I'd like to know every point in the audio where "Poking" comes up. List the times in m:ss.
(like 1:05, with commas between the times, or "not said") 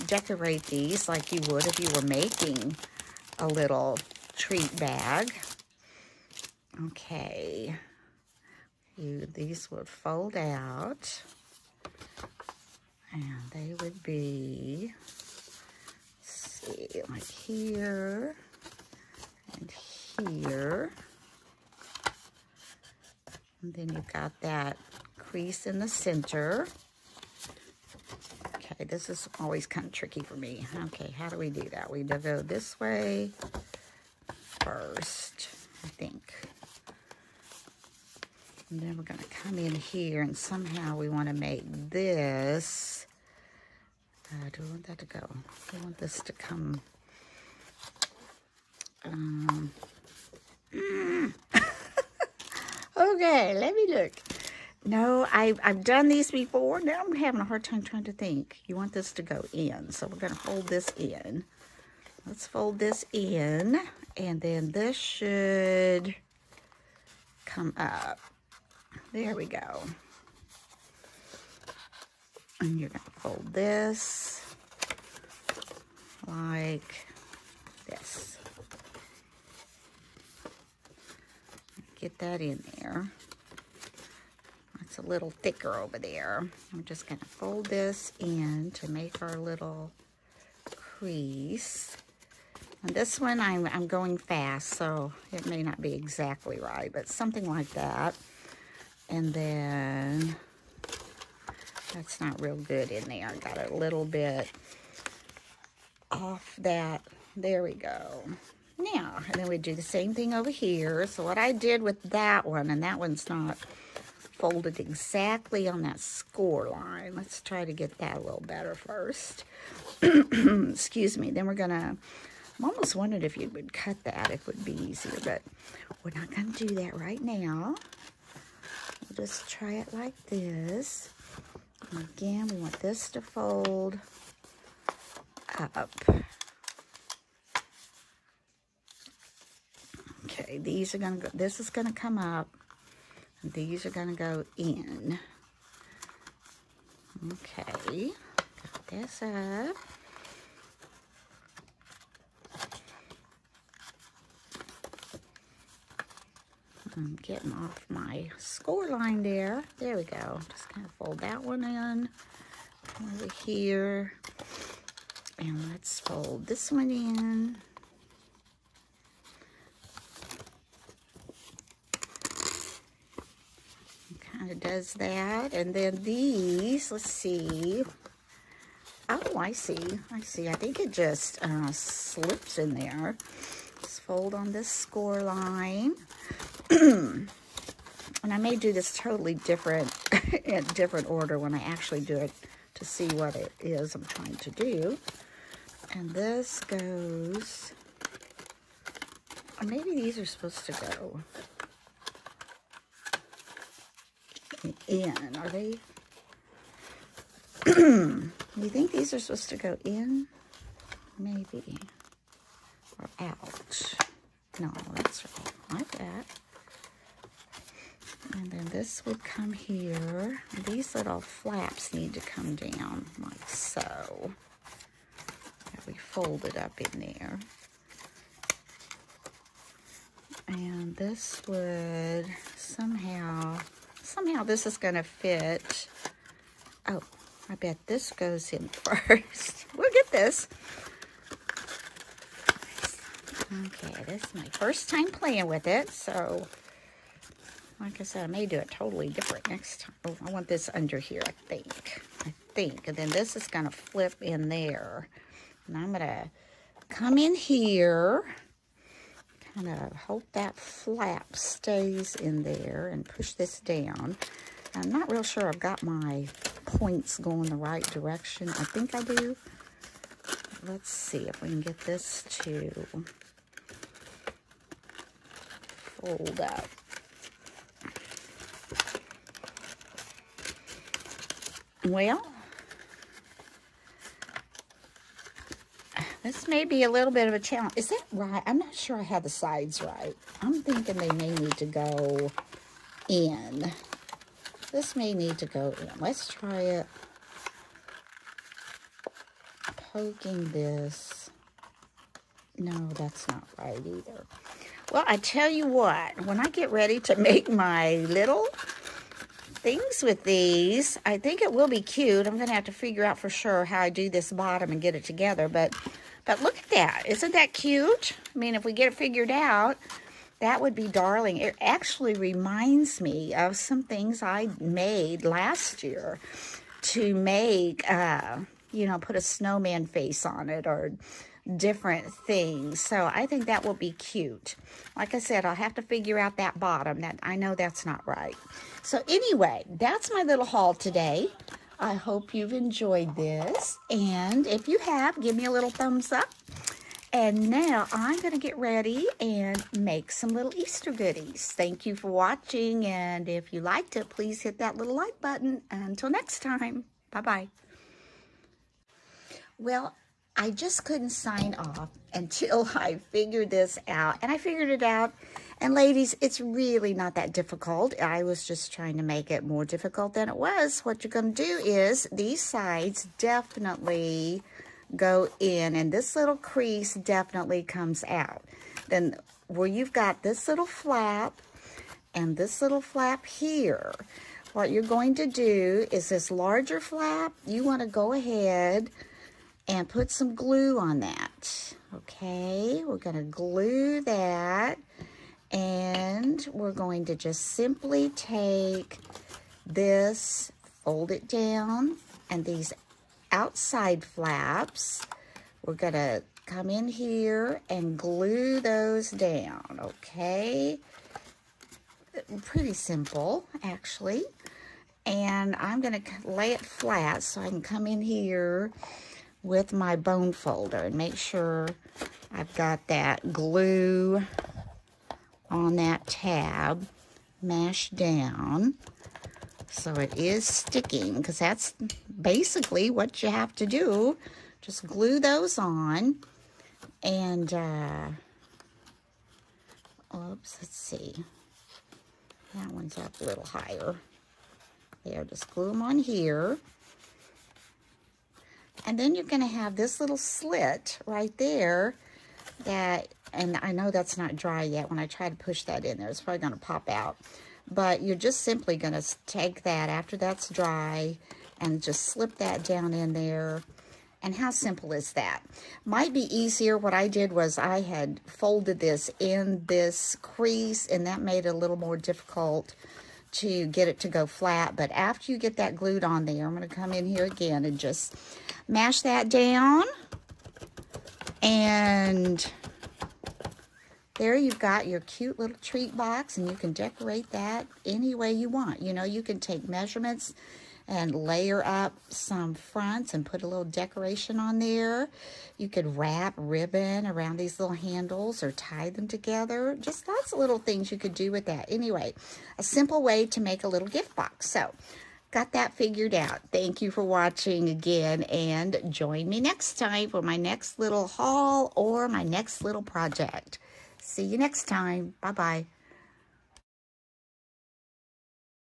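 4:59.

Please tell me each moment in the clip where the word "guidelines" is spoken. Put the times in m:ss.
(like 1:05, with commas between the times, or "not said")
not said.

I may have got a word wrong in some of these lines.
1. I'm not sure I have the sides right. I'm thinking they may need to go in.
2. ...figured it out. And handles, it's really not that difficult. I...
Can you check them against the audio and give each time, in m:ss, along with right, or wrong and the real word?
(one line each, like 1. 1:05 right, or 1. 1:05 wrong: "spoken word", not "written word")
1. 4:48 right
2. 6:04 wrong: "ladies", not "handles".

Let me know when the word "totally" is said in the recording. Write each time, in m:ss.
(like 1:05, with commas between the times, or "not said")
3:08, 4:08.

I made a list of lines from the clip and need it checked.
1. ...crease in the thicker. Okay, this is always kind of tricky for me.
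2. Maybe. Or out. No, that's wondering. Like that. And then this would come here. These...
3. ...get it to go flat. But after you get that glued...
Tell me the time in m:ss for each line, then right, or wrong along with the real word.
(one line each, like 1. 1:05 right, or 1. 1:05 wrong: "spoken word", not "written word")
1. 0:25 wrong: "center", not "thicker"
2. 3:31 wrong: "wrong", not "wondering"
3. 7:53 right.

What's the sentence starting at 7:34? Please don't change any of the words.
When I try to push that in there, it's probably going to pop out.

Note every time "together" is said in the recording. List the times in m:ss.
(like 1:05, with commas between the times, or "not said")
5:15, 8:19.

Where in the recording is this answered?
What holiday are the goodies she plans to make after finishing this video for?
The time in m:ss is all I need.
5:50.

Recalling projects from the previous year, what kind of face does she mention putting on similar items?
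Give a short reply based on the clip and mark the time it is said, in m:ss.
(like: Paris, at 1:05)
snowman face, at 5:29.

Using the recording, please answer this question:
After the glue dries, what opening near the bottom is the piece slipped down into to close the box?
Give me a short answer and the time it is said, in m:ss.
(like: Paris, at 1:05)
little slit, at 7:29.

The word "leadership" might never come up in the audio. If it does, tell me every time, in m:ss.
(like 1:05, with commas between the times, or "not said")
not said.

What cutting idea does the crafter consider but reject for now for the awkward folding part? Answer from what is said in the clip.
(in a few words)
cut that.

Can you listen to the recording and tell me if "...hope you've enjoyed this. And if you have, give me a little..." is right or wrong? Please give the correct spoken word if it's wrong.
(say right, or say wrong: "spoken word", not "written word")
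right.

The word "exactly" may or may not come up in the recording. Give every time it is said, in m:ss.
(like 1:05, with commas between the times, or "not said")
1:35, 1:54.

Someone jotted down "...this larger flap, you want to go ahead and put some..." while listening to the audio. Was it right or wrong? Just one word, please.
right.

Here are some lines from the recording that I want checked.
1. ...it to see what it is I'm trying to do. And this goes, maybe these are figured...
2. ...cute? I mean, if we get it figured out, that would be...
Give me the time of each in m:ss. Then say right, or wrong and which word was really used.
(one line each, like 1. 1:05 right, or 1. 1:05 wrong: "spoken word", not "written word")
1. 3:12 wrong: "supposed", not "figured"
2. 5:17 right.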